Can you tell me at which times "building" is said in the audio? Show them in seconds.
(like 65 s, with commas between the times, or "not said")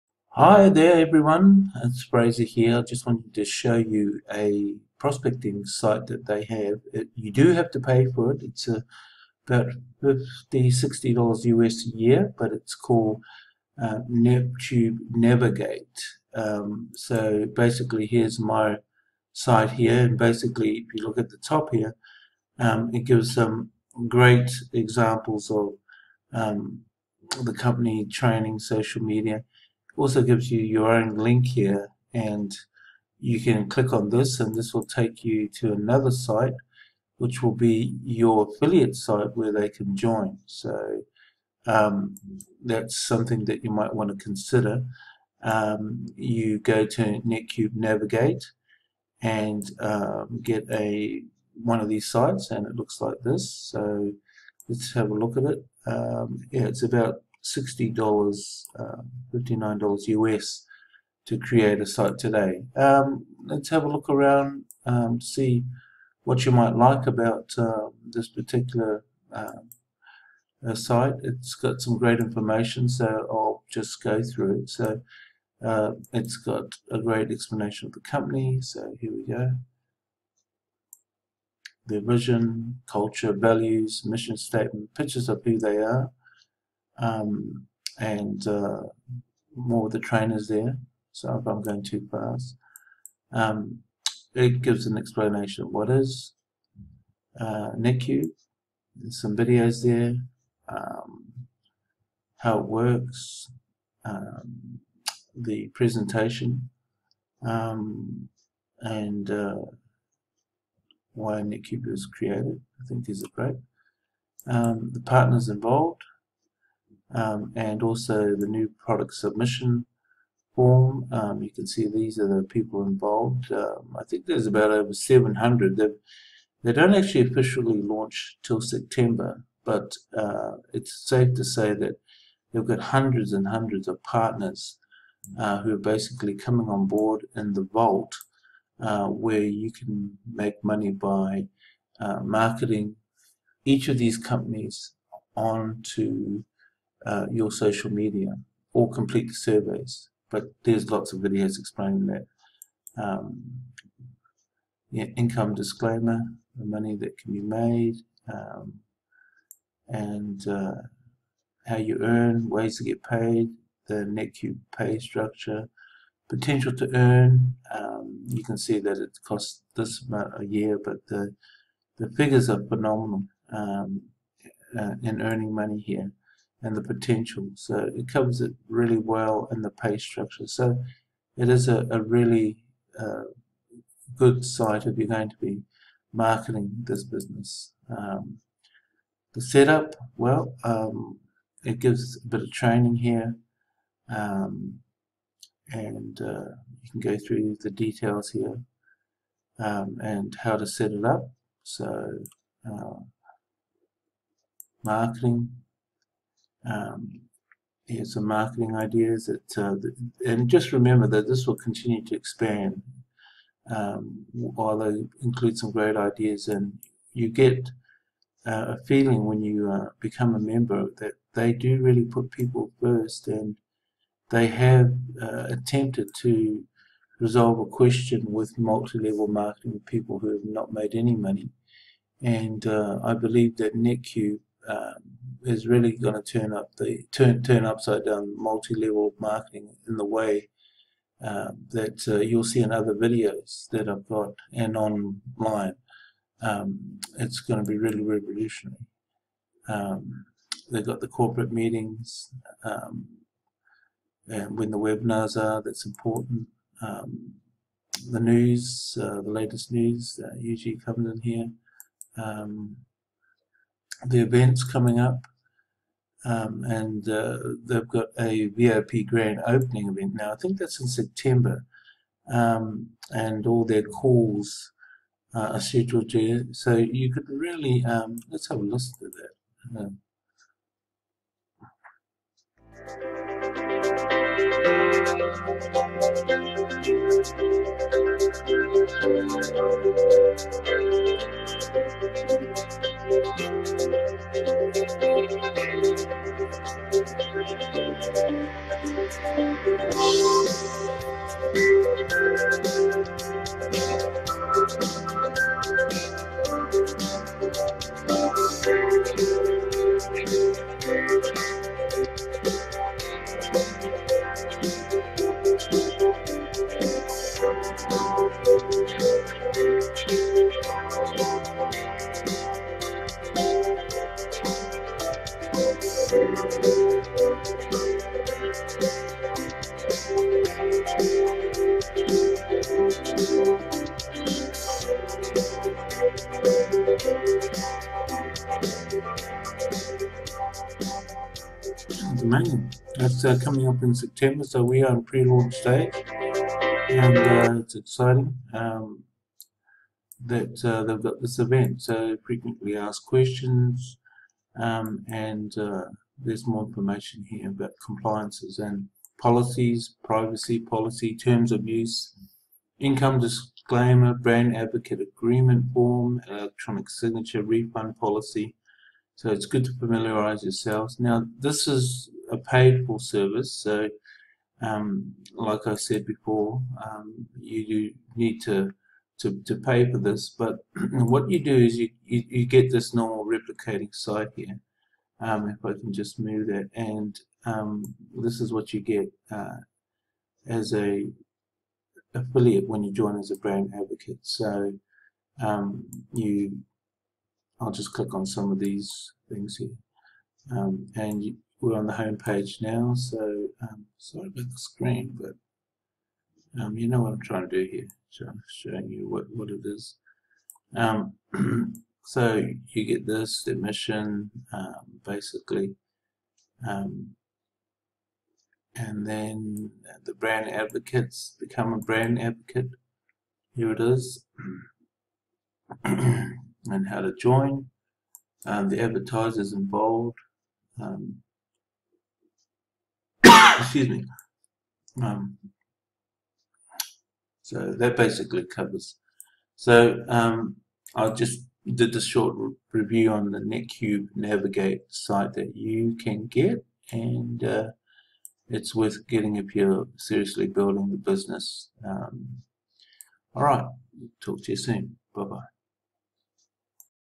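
450 s.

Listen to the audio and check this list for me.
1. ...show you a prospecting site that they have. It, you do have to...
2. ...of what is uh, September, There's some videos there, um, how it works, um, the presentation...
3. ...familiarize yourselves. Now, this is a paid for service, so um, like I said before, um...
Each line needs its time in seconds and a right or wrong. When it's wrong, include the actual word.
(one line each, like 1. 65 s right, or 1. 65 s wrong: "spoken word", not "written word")
1. 3 s right
2. 95 s wrong: "NetQube", not "September"
3. 369 s right.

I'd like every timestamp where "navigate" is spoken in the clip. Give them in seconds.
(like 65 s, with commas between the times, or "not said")
14 s, 47 s, 444 s.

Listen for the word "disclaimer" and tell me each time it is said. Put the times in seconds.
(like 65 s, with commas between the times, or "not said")
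155 s, 363 s.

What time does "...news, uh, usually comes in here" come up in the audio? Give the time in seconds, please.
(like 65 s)
259 s.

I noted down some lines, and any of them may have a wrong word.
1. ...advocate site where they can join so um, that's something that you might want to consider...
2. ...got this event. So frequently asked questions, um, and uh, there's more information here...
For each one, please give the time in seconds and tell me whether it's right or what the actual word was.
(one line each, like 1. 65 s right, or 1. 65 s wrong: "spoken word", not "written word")
1. 38 s wrong: "affiliate", not "advocate"
2. 351 s right.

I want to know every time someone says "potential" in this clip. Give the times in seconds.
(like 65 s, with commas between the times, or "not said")
166 s, 176 s.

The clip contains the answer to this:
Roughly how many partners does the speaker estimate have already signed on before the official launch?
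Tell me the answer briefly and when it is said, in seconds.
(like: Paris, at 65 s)
over 700, at 124 s.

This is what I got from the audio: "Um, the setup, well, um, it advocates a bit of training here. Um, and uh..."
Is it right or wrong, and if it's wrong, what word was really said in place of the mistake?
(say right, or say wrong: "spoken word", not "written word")
wrong: "gives", not "advocates".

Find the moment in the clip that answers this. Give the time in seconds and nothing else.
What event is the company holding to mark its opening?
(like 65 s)
268 s.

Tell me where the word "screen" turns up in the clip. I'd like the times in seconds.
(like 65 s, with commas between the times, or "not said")
404 s.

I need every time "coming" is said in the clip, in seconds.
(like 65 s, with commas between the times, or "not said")
136 s, 264 s, 343 s.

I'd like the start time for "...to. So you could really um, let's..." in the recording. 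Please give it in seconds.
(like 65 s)
276 s.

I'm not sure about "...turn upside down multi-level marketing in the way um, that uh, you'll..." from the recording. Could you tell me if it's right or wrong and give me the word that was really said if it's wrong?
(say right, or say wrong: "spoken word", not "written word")
right.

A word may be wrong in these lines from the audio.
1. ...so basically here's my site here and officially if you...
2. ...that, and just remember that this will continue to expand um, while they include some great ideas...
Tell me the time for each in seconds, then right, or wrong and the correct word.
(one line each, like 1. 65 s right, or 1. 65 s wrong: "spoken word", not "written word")
1. 16 s wrong: "basically", not "officially"
2. 209 s right.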